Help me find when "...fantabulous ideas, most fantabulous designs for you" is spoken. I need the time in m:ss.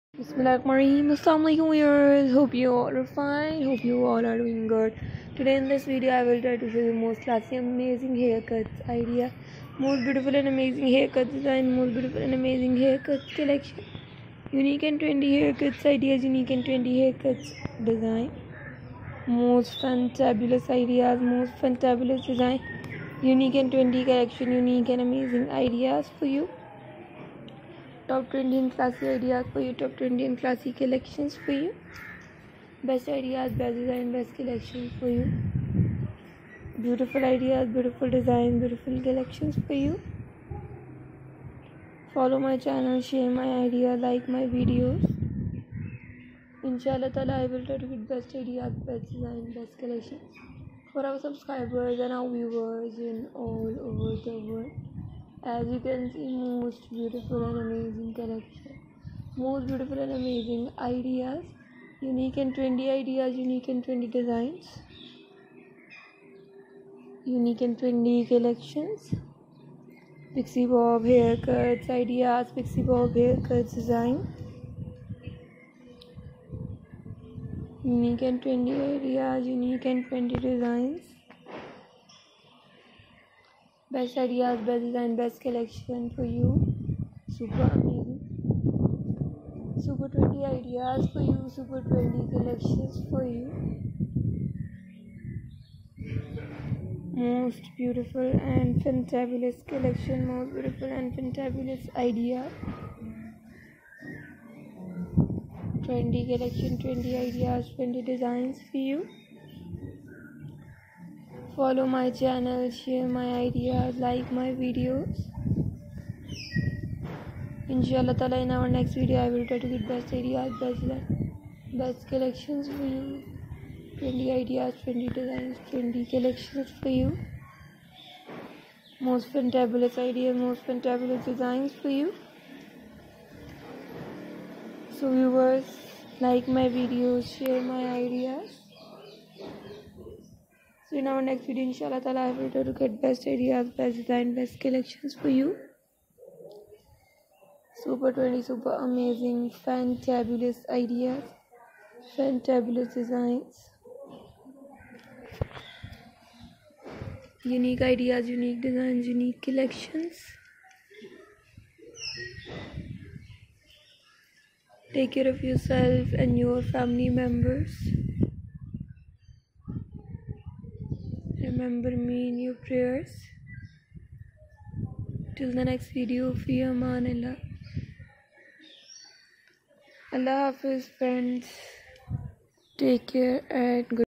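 2:09.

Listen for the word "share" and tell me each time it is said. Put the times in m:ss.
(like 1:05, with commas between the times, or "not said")
1:52, 2:17.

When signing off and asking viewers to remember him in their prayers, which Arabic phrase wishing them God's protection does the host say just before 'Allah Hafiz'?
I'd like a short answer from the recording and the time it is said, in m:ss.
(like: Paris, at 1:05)
Fi aman Allah, at 2:56.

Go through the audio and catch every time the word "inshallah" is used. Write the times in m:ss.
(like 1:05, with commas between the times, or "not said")
1:57, 2:21.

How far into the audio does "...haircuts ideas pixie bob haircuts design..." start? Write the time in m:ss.
1:11.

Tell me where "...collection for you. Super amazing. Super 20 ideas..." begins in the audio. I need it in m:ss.
1:25.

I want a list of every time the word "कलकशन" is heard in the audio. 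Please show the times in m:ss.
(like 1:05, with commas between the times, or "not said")
0:34, 0:39, 0:49.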